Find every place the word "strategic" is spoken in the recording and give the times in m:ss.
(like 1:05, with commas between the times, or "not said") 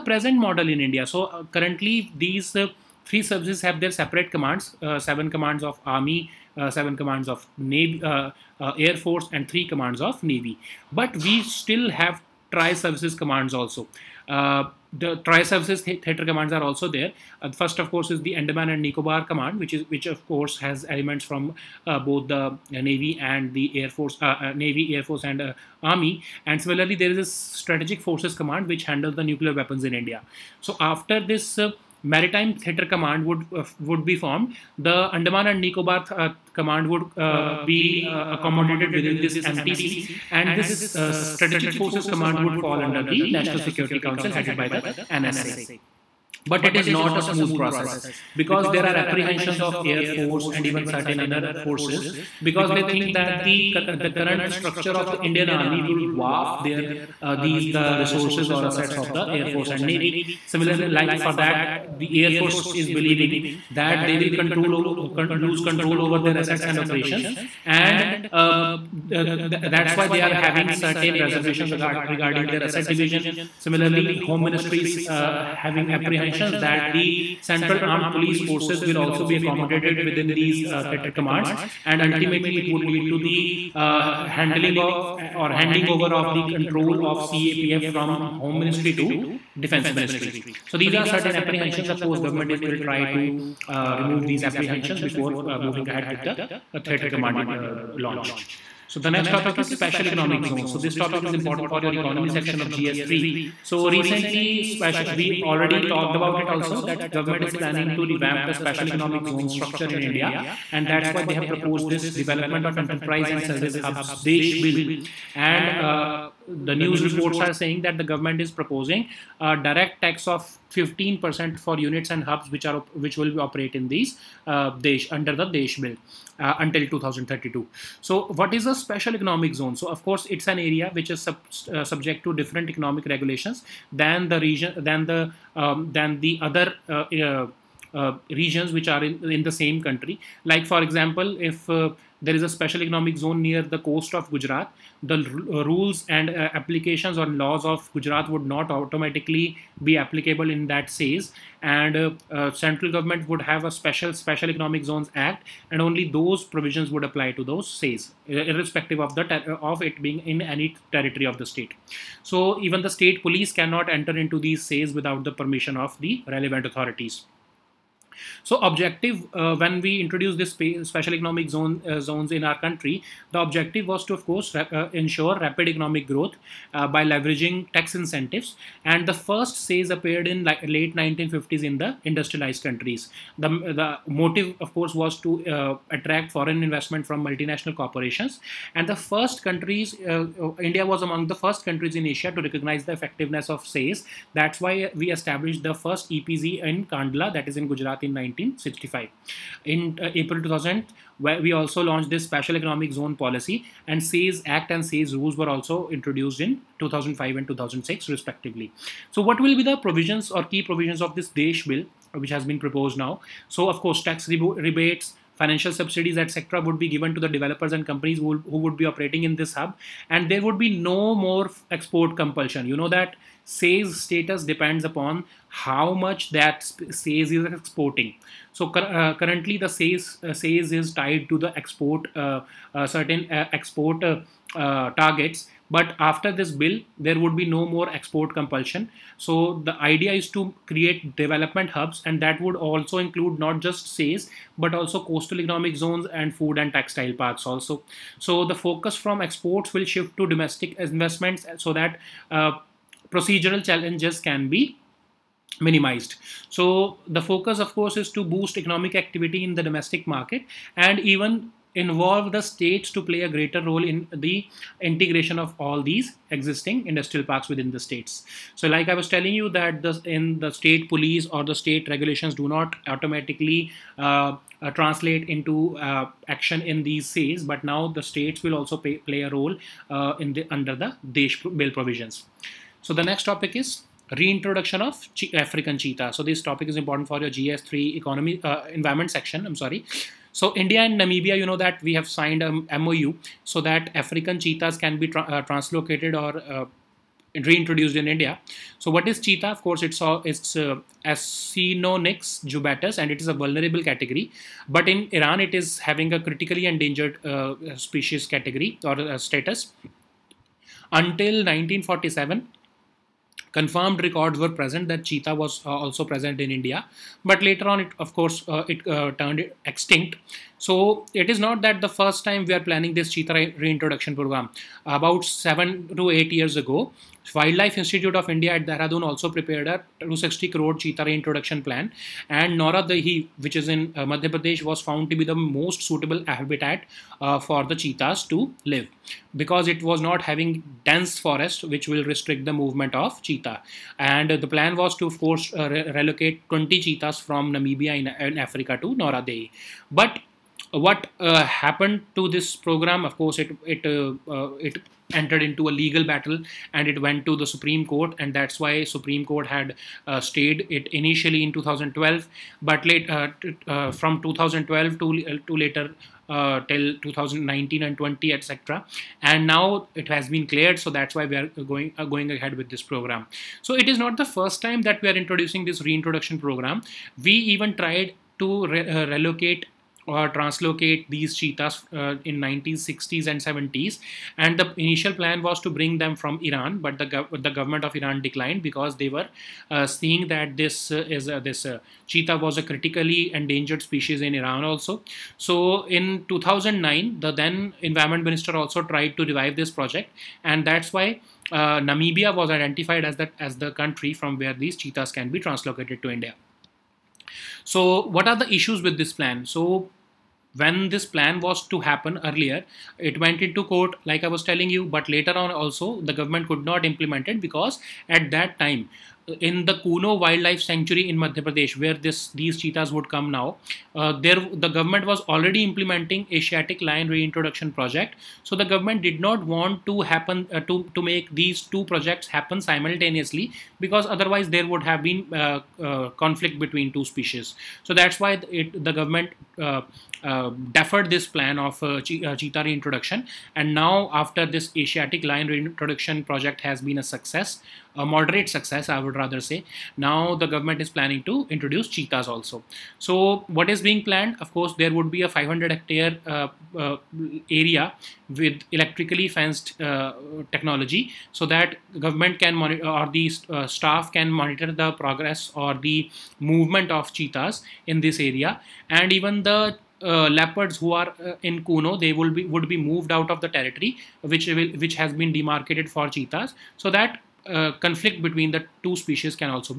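0:27, 0:41.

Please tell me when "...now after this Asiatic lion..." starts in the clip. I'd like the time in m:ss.
7:23.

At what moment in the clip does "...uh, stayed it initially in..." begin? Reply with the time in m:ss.
6:00.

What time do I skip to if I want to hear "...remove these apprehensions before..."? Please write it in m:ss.
1:33.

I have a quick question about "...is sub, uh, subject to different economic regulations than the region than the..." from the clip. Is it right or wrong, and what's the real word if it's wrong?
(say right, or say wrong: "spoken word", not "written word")
right.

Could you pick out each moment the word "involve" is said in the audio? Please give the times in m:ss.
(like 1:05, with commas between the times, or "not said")
4:21.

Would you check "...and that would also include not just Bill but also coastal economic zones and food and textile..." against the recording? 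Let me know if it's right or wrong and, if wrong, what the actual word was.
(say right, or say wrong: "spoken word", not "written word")
wrong: "SEZs", not "Bill".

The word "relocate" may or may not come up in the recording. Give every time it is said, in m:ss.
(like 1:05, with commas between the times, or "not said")
5:45, 6:19.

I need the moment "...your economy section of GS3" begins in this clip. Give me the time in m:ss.
1:41.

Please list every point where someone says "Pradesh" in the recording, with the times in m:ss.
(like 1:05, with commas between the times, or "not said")
5:34, 7:01.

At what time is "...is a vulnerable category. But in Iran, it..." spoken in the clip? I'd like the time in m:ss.
5:03.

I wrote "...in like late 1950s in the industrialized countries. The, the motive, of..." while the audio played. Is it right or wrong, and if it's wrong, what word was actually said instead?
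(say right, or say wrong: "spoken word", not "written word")
right.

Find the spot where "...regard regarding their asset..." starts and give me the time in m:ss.
1:11.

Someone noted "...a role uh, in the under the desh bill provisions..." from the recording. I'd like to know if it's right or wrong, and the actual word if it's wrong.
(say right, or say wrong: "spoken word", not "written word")
right.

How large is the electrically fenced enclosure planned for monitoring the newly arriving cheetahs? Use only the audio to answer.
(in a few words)
500 hectares.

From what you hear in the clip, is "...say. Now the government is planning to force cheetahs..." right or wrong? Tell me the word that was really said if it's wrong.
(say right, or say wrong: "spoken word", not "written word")
wrong: "introduce", not "force".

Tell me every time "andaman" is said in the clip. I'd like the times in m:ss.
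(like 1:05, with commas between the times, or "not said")
0:18, 0:35.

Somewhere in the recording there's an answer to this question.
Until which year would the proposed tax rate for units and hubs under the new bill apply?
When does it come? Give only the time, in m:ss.
2:06.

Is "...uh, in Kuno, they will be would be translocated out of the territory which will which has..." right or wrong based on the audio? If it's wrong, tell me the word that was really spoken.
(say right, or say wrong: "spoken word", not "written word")
wrong: "moved", not "translocated".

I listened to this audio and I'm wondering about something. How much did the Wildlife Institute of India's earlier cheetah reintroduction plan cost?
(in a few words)
260 crore.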